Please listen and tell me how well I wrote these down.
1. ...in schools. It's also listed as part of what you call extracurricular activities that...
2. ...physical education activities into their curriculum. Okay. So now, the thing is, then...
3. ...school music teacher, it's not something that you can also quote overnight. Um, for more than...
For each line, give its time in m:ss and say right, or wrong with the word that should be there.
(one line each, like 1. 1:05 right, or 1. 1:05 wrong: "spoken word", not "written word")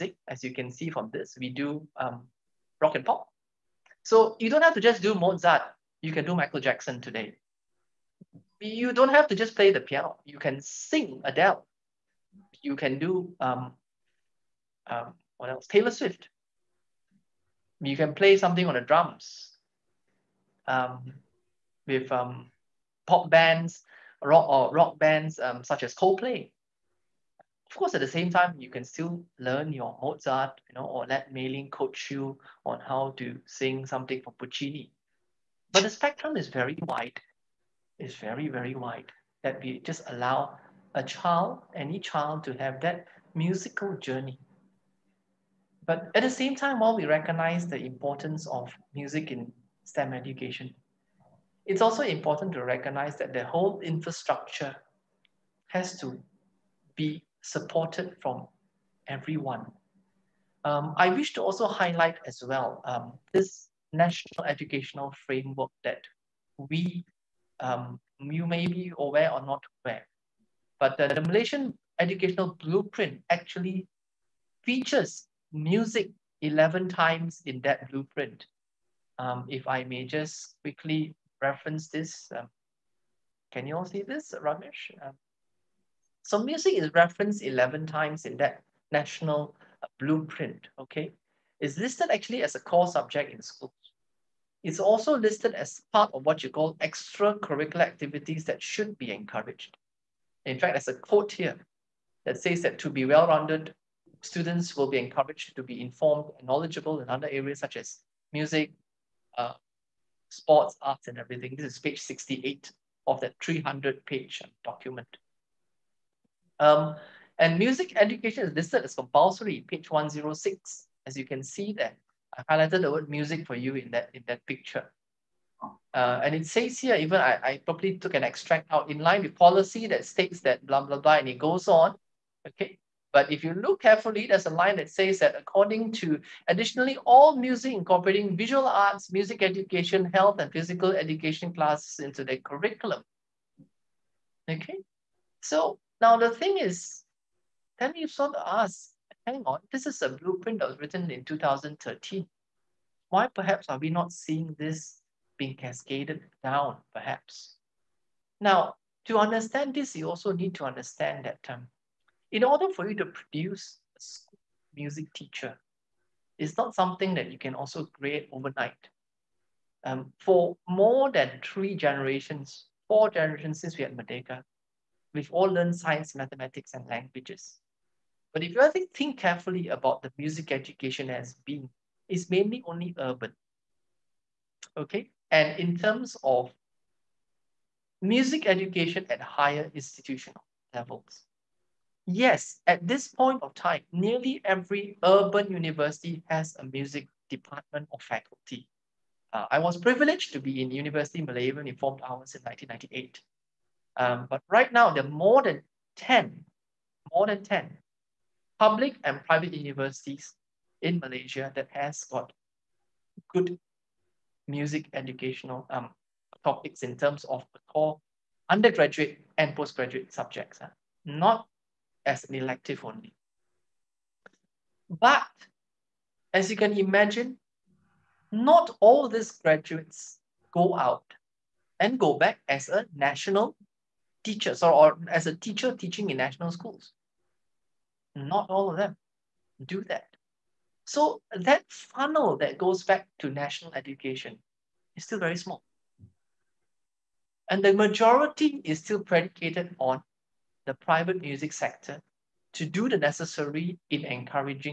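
1. 1:33 right
2. 2:20 wrong: "classes", not "activities"
3. 2:44 wrong: "create", not "quote".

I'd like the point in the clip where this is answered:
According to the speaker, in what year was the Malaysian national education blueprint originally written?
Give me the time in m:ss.
2:31.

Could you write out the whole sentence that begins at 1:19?
Um, if I may just quickly reference this.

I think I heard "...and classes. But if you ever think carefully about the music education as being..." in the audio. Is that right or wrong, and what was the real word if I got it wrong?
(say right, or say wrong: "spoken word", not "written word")
wrong: "languages", not "classes".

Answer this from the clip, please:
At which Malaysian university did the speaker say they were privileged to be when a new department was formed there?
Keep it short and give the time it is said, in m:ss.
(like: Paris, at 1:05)
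University Malaya, at 3:20.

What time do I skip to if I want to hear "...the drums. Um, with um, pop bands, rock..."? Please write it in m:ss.
0:18.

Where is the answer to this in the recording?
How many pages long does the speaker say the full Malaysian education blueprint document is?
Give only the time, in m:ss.
1:53.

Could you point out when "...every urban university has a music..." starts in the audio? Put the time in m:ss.
3:14.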